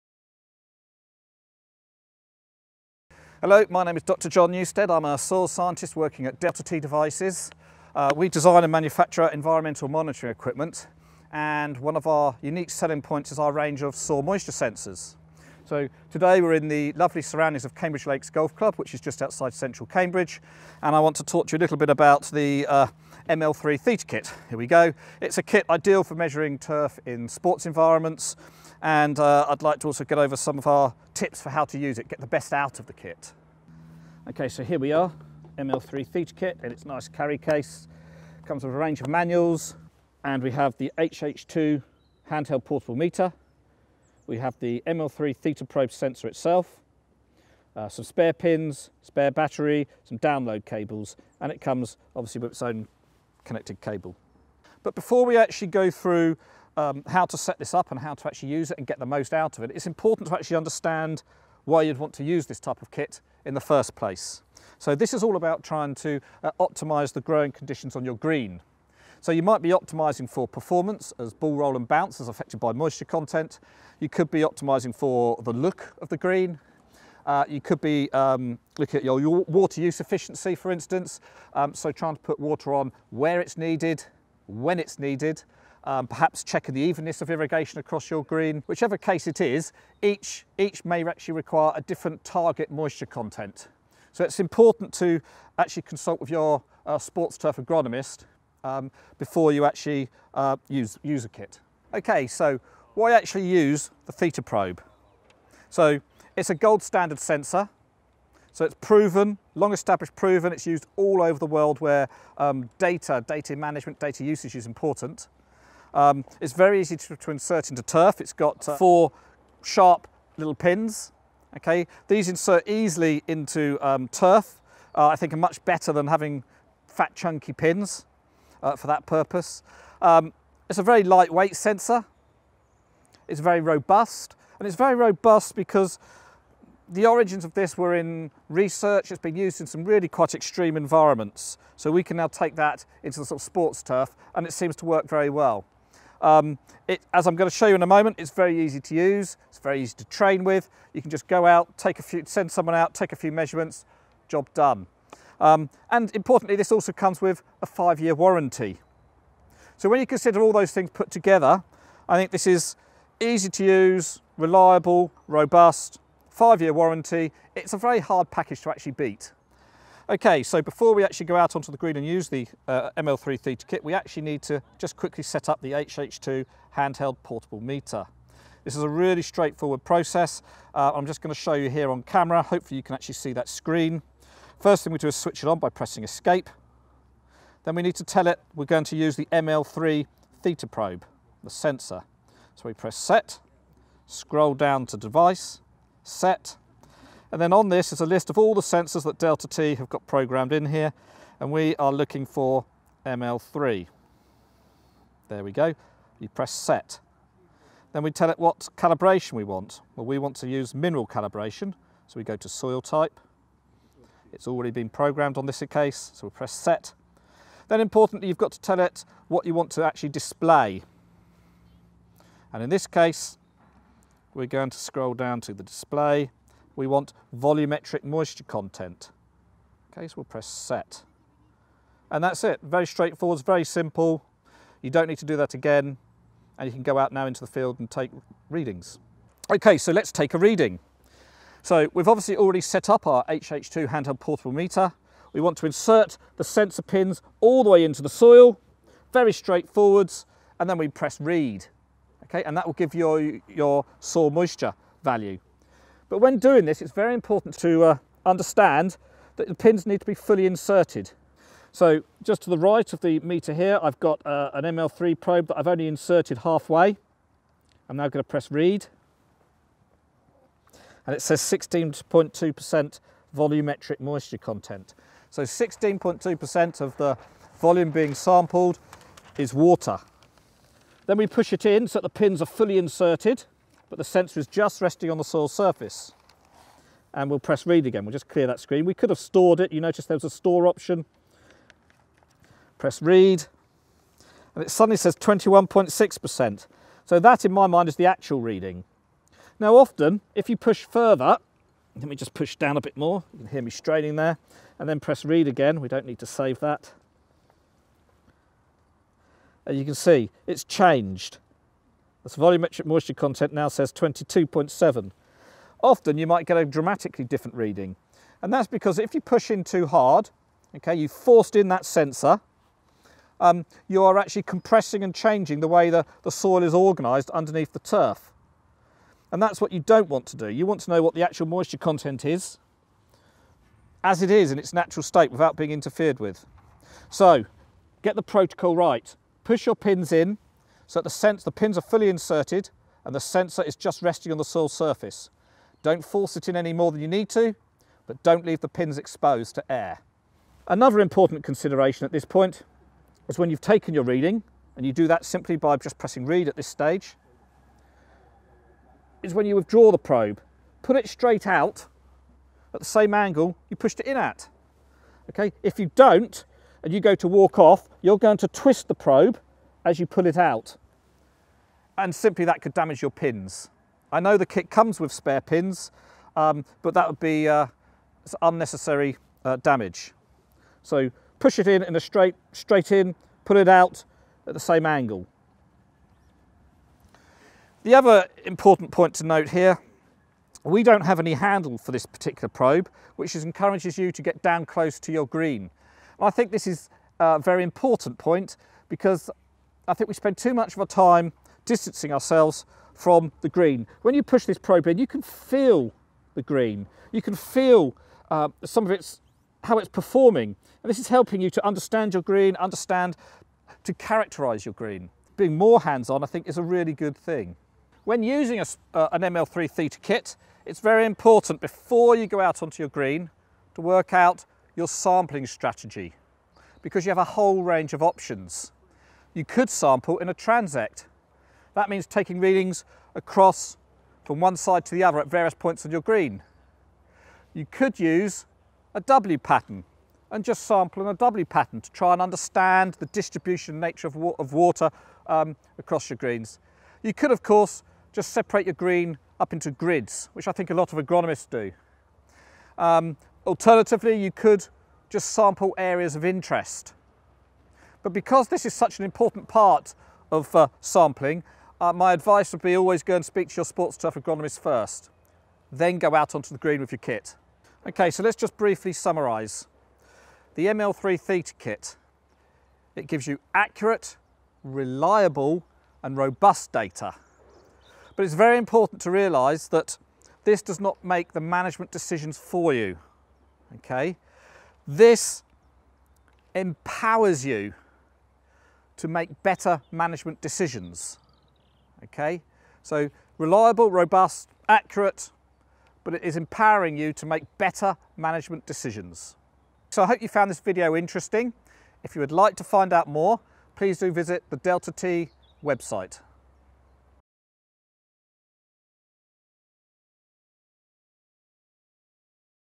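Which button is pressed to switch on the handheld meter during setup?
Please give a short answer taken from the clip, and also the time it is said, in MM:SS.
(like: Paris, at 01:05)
Escape, at 03:06.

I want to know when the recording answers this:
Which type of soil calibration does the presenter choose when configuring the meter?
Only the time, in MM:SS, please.
03:30.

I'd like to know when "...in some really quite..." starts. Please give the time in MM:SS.
02:19.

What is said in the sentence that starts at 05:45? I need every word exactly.
Don't force it in any more than you need to, but don't leave the pins exposed to air.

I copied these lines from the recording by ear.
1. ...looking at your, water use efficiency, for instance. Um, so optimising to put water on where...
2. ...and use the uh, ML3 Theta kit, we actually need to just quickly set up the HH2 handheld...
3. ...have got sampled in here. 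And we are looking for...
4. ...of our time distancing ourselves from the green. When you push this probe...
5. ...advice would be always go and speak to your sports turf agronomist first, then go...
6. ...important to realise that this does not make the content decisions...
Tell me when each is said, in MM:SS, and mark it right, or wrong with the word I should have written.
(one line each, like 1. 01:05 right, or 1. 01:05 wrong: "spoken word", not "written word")
1. 01:18 wrong: "trying", not "optimising"
2. 02:51 right
3. 03:19 wrong: "programmed", not "sampled"
4. 06:40 right
5. 07:42 right
6. 07:58 wrong: "management", not "content".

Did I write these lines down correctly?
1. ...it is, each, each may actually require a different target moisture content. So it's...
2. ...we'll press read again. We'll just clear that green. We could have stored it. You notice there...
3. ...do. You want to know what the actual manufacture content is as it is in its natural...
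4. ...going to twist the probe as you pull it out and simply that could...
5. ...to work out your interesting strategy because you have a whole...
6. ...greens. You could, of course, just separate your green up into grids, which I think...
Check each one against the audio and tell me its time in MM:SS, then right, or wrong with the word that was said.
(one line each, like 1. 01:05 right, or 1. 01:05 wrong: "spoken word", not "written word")
1. 01:29 right
2. 04:47 wrong: "screen", not "green"
3. 05:30 wrong: "moisture", not "manufacture"
4. 06:08 right
5. 07:03 wrong: "sampling", not "interesting"
6. 07:26 right.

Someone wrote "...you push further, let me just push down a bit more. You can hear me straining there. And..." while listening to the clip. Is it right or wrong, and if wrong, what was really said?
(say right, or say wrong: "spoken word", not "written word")
right.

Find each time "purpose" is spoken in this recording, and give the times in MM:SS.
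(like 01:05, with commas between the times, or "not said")
02:09.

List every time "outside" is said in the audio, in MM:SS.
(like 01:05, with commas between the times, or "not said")
00:19.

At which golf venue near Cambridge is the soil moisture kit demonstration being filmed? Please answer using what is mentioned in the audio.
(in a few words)
Cambridge Lakes Golf Club.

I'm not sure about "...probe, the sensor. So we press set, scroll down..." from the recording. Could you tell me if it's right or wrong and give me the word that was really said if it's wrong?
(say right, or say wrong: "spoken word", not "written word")
right.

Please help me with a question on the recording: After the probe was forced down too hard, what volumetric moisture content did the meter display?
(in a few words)
22.7.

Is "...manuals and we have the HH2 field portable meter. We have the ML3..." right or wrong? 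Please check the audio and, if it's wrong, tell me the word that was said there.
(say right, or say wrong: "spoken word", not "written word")
wrong: "handheld", not "field".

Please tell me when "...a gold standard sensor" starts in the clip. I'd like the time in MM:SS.
01:46.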